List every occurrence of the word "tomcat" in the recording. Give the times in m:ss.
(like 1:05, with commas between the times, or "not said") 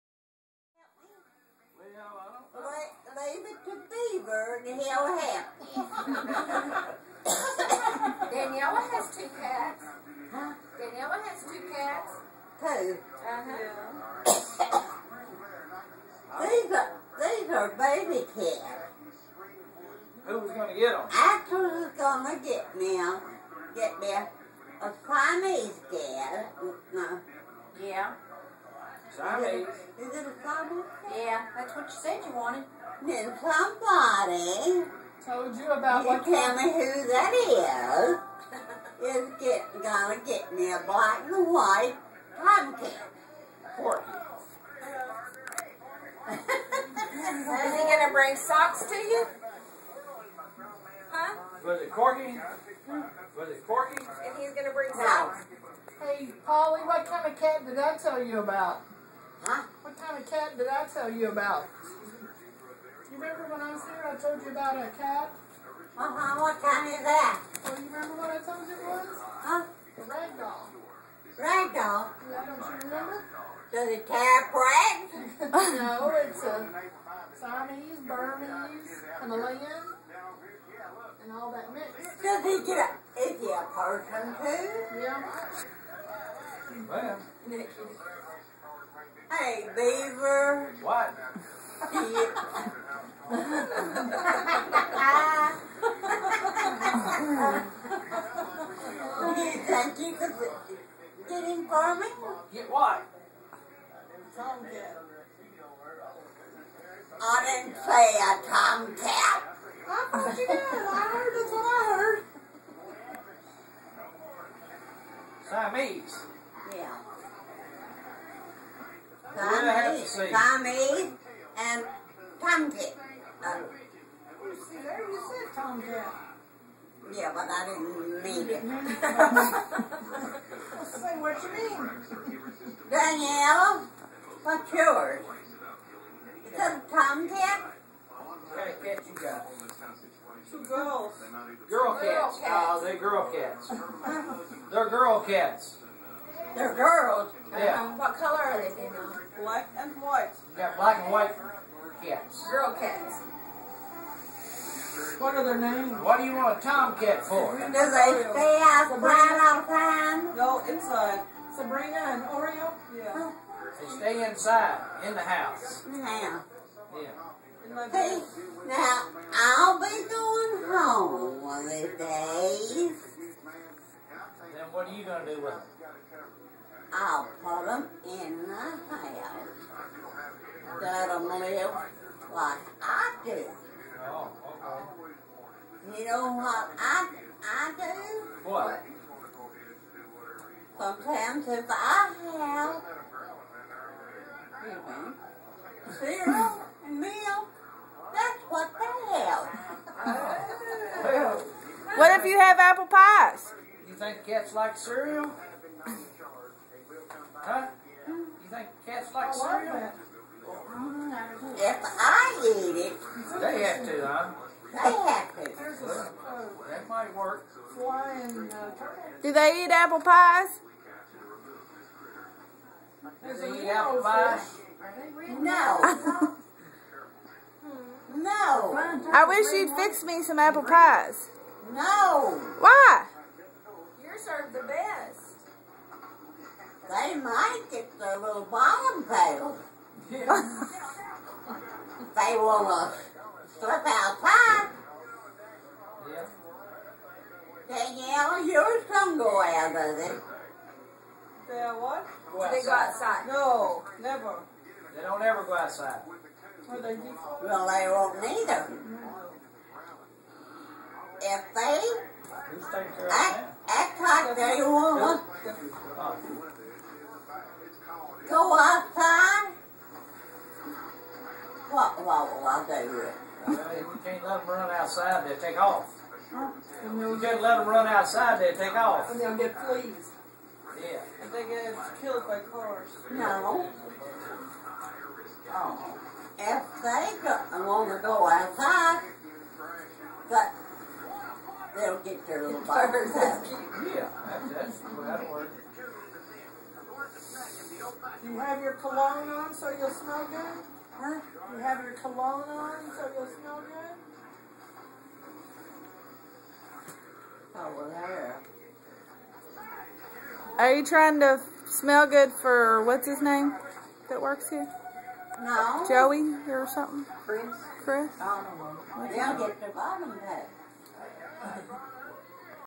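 1:44, 1:48, 2:36.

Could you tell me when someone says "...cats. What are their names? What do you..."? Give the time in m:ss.
2:32.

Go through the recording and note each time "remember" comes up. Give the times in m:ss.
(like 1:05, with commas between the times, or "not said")
1:03, 1:07, 1:12.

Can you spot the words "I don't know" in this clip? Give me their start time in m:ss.
5:18.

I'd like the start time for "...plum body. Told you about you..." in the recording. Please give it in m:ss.
0:33.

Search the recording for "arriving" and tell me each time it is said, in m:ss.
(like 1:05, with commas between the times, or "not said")
not said.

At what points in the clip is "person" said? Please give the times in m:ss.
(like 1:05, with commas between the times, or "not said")
1:23.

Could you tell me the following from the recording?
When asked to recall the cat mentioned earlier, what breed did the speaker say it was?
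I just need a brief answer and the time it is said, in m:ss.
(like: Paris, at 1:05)
Ragdoll, at 1:09.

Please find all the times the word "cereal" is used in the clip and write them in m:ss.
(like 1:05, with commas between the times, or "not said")
3:15, 3:24, 3:29.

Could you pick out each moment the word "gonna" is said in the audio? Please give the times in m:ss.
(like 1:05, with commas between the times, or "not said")
0:39, 0:47, 0:54.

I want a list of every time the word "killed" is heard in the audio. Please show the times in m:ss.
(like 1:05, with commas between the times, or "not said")
4:42.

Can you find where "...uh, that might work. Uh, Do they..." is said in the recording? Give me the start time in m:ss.
3:36.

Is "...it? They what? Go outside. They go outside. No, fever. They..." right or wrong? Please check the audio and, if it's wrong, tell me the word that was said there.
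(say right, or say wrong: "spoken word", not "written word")
wrong: "never", not "fever".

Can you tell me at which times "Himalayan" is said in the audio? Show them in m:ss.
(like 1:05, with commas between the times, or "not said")
1:19.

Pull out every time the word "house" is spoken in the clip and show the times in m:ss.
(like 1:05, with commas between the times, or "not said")
2:45, 2:58.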